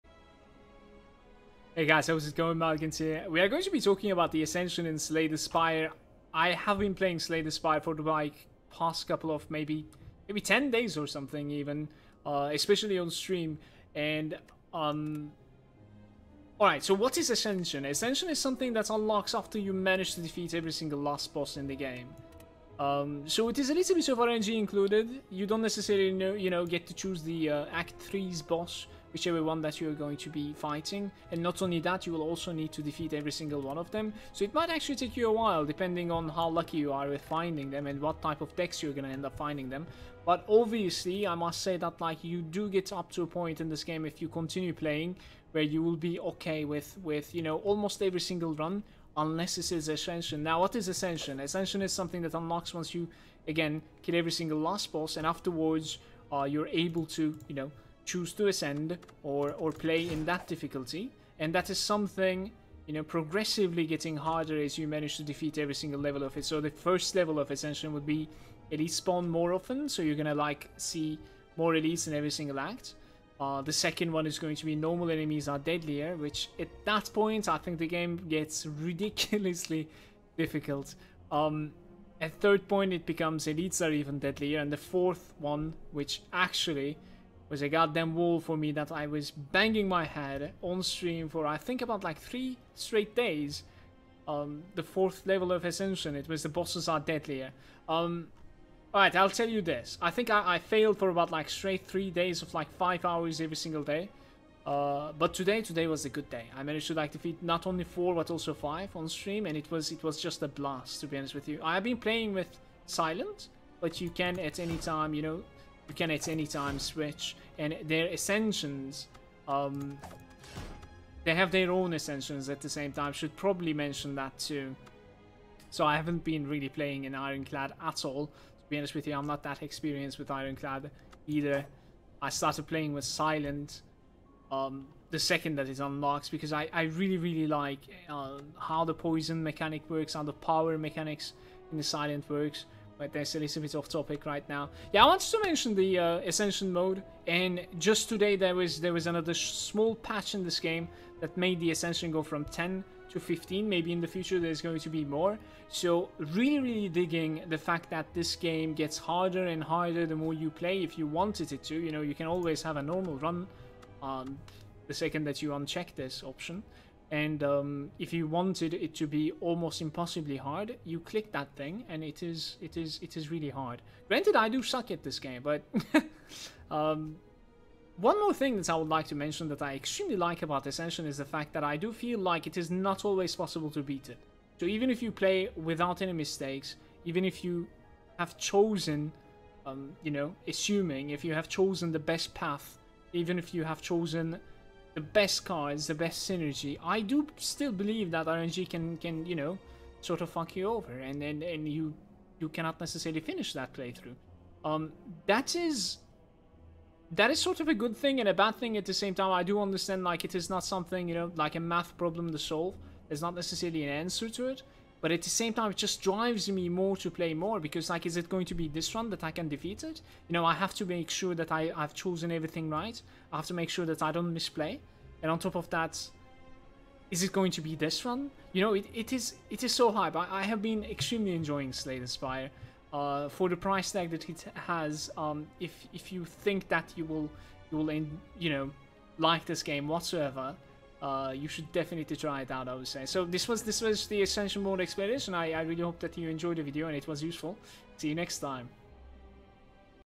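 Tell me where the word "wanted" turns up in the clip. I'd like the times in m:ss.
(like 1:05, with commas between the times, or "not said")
2:25, 2:41, 2:48.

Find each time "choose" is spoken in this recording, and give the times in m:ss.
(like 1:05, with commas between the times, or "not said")
0:26, 0:58.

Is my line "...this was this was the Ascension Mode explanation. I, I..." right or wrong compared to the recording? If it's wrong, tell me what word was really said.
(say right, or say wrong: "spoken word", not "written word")
right.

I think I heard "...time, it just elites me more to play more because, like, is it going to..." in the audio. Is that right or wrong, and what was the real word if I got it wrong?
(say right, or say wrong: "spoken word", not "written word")
wrong: "drives", not "elites".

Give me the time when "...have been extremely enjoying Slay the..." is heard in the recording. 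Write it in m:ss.
3:50.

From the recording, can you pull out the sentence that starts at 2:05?
So I haven't been really playing in Ironclad at all be honest with you, I'm not that experienced with Ironclad either.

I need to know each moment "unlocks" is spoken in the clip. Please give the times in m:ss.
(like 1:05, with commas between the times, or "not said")
0:18, 0:52, 2:15.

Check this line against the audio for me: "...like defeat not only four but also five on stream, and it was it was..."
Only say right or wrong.
right.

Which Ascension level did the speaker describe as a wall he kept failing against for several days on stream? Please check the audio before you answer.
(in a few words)
4.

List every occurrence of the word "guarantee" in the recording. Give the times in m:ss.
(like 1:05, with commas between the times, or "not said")
not said.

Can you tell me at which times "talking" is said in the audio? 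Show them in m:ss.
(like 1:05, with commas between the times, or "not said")
0:03.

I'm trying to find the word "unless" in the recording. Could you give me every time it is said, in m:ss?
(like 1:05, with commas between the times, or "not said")
0:49.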